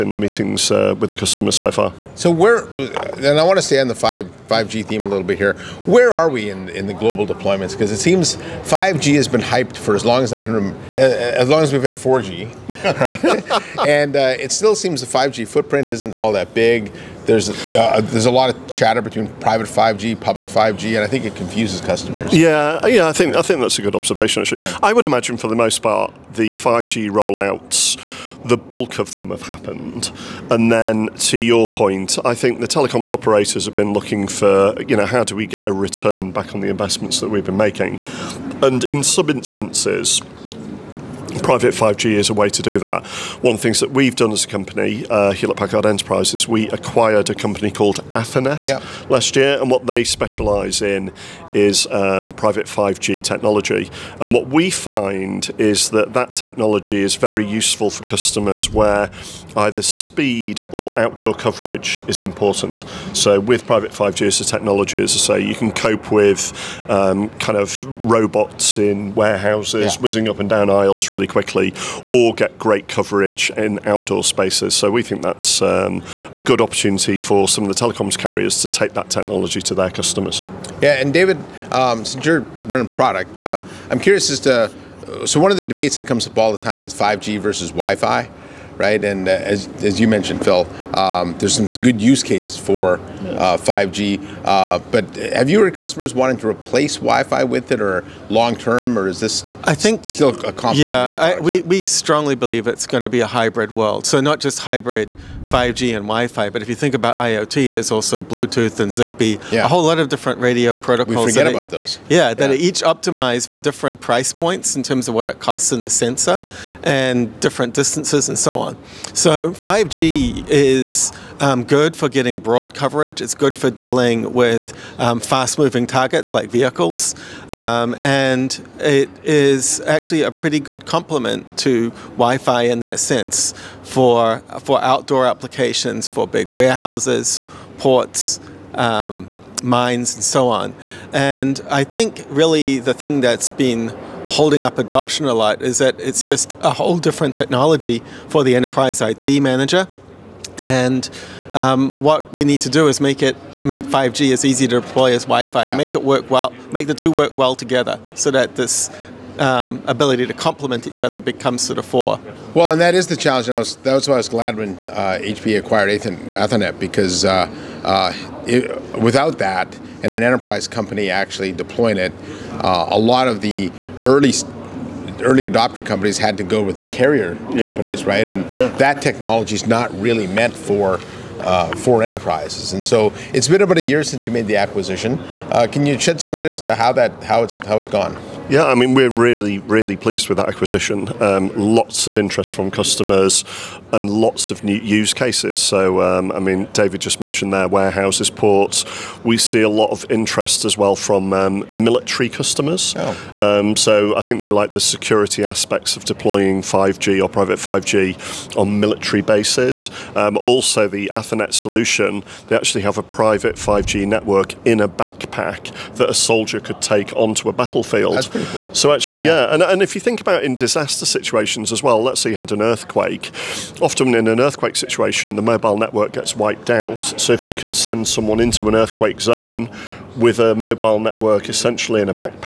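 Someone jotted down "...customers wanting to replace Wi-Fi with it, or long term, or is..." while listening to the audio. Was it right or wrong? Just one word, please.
right.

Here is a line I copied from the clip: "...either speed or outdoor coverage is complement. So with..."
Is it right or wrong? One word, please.
wrong.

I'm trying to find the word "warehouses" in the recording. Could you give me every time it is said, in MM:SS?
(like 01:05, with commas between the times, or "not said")
01:09, 02:16, 03:17.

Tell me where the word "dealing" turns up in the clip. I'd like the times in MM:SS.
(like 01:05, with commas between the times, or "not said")
02:03.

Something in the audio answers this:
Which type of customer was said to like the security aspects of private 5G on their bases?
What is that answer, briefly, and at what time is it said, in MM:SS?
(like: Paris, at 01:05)
Military customers, at 03:21.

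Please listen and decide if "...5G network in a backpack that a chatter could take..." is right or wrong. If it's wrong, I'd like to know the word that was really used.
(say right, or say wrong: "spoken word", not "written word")
wrong: "soldier", not "chatter".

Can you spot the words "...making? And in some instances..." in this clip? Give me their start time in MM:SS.
00:37.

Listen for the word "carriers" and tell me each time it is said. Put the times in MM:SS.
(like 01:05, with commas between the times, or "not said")
01:18, 02:56.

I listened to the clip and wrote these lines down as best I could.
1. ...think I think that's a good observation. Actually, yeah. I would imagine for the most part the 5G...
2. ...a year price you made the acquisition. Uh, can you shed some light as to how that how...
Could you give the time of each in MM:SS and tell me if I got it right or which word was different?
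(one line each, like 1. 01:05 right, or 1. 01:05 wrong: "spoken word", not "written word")
1. 00:23 right
2. 03:03 wrong: "since", not "price".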